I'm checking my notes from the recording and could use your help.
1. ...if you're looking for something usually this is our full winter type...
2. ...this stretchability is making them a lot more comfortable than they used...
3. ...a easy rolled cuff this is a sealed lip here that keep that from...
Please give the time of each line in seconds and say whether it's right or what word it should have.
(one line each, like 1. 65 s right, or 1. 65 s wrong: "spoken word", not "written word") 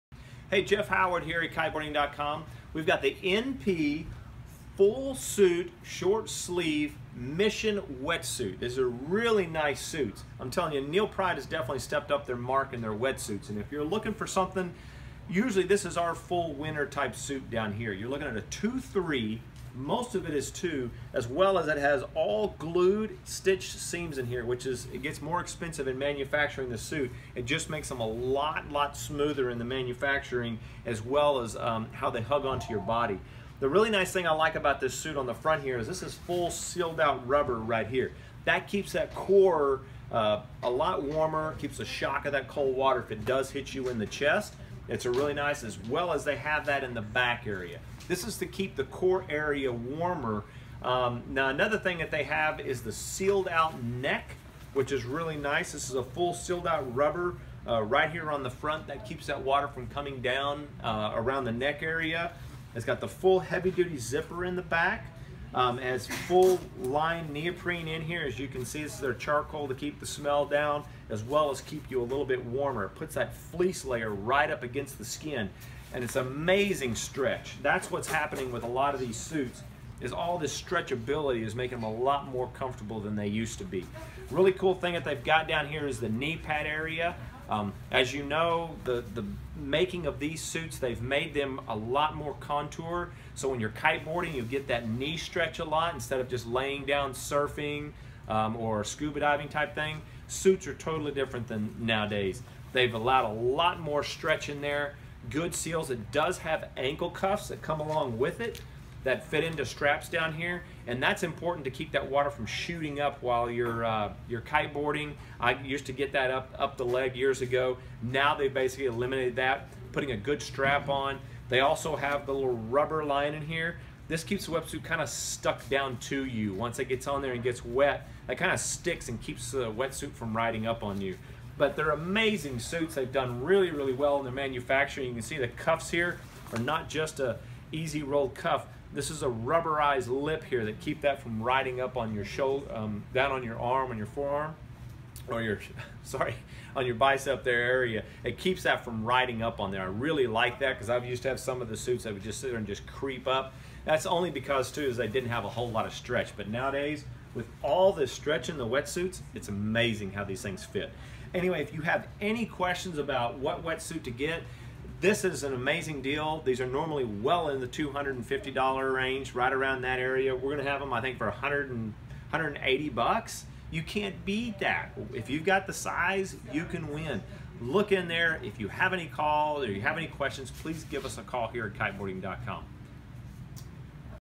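1. 13 s right
2. 80 s right
3. 137 s wrong: "rubberized", not "sealed".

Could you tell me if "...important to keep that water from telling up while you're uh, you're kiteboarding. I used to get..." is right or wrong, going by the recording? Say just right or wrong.
wrong.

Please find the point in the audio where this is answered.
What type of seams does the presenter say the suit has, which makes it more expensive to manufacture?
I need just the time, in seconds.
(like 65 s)
22 s.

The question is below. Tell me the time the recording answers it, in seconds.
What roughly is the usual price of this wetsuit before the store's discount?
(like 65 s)
167 s.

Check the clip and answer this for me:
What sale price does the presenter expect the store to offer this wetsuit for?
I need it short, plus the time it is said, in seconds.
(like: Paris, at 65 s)
$180, at 172 s.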